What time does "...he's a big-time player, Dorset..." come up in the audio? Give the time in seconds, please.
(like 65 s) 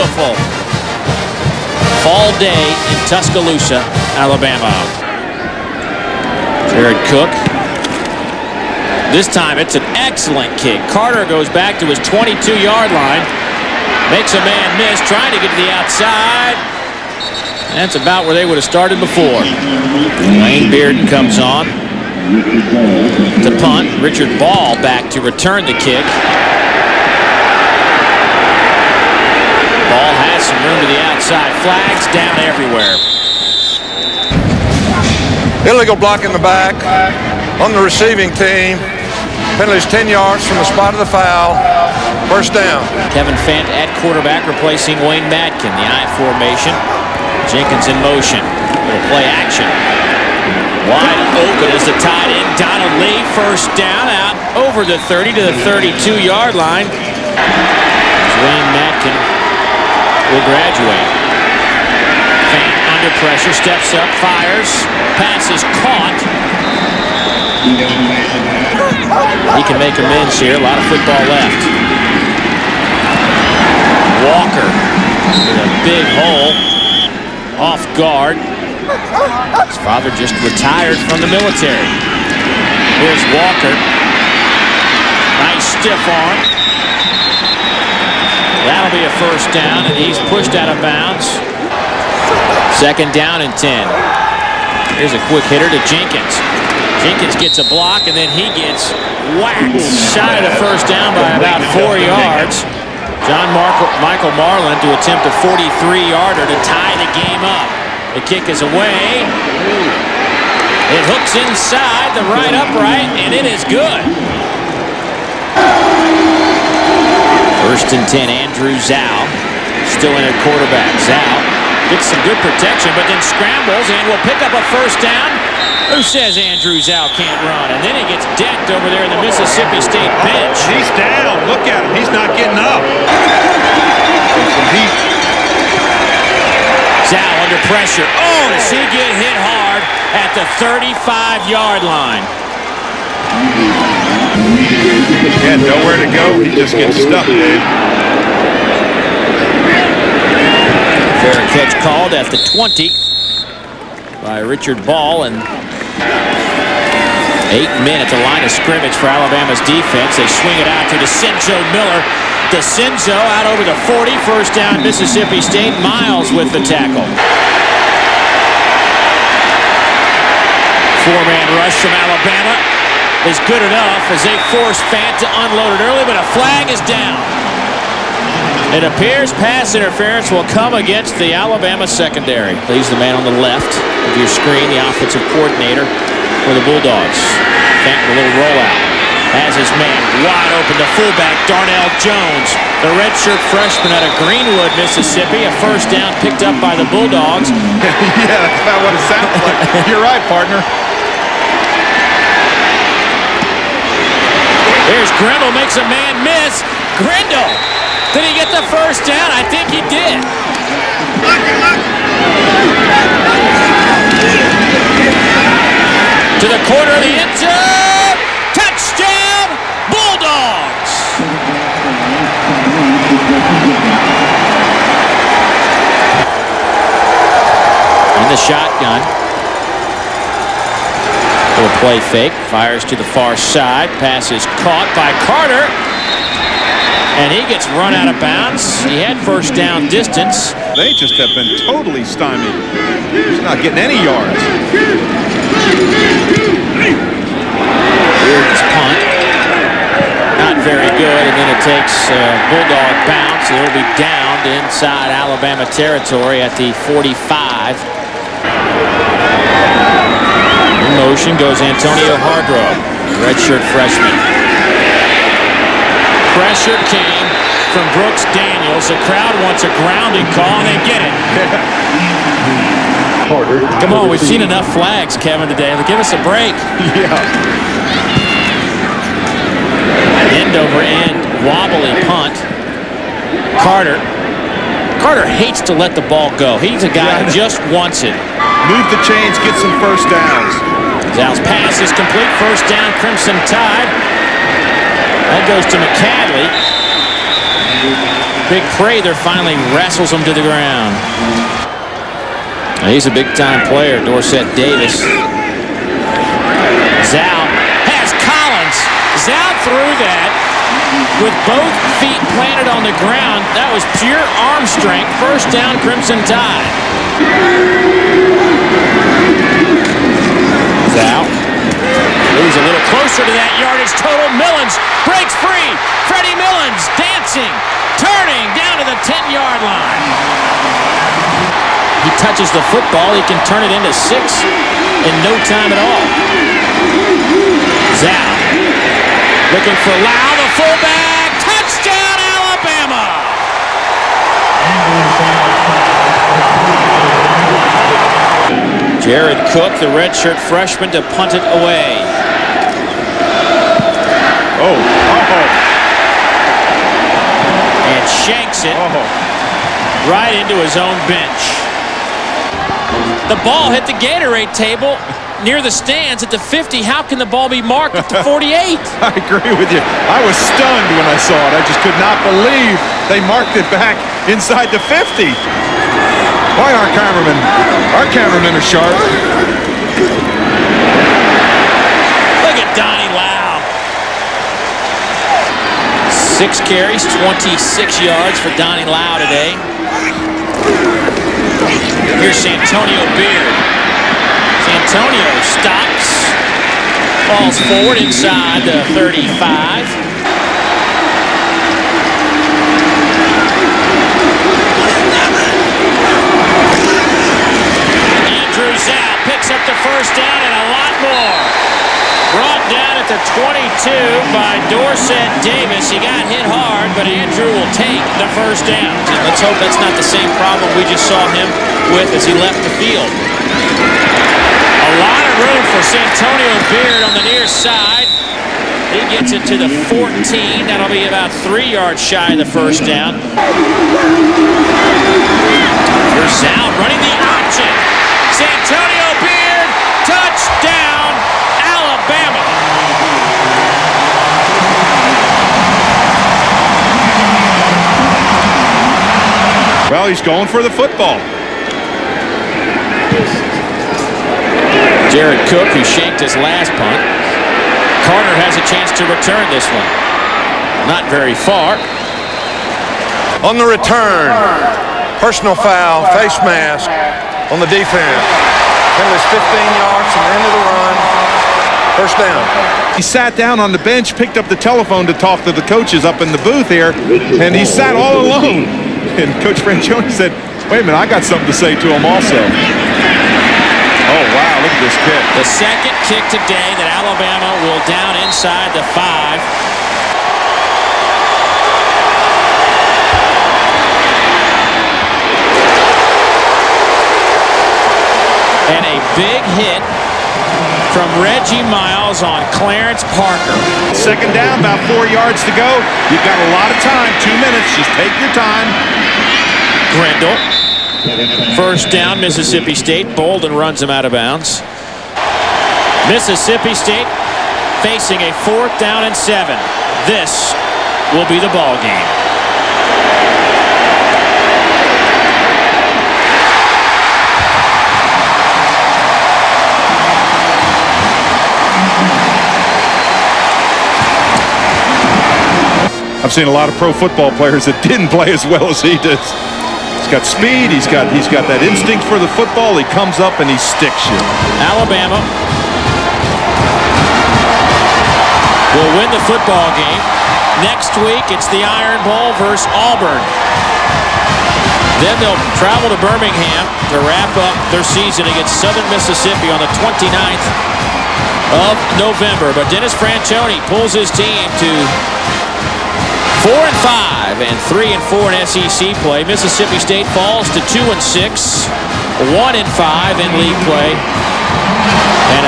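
302 s.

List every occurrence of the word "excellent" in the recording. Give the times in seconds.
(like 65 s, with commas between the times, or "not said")
9 s.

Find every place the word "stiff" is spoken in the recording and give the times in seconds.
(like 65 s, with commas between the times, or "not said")
85 s.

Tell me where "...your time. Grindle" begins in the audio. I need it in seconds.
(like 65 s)
508 s.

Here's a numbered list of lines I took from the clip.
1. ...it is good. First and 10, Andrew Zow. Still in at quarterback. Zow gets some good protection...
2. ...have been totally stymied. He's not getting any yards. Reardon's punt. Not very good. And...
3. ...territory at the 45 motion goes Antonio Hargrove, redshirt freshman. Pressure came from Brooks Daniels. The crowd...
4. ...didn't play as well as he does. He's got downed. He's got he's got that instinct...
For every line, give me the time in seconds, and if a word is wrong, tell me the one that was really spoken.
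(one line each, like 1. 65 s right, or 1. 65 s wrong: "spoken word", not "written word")
1. 113 s right
2. 241 s right
3. 255 s right
4. 537 s wrong: "speed", not "downed".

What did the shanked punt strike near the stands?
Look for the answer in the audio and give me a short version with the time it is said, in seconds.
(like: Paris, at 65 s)
The Gatorade table, at 363 s.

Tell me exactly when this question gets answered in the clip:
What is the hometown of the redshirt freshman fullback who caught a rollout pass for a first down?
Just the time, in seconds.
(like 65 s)
194 s.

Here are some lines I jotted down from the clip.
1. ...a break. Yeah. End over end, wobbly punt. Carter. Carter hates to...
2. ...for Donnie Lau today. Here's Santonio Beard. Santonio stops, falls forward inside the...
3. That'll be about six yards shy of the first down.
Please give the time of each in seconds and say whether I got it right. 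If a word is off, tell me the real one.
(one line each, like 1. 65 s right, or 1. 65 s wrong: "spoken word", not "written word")
1. 276 s right
2. 388 s right
3. 430 s wrong: "three", not "six".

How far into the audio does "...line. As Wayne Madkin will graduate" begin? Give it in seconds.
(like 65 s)
56 s.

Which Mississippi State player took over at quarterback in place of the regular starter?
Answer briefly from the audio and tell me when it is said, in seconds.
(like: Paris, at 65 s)
Kevin Fant, at 43 s.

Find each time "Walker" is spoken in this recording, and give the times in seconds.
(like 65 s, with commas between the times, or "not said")
74 s, 83 s.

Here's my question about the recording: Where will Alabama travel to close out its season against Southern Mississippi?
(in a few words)
Birmingham.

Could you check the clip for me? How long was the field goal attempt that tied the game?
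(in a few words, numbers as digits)
43 yards.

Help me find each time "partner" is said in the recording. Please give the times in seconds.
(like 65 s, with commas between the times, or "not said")
200 s.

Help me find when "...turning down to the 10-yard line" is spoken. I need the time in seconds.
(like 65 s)
328 s.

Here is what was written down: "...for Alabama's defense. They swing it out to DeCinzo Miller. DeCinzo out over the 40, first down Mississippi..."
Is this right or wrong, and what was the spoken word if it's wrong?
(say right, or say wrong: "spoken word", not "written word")
right.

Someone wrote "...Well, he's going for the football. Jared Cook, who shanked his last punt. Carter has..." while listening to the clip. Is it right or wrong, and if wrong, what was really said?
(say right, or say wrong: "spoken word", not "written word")
right.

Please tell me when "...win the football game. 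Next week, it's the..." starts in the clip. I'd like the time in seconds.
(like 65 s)
549 s.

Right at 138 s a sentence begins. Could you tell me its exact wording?
Oh, does he get hit hard at the 35-yard line?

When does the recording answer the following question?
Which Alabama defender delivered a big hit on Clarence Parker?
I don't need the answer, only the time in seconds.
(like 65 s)
501 s.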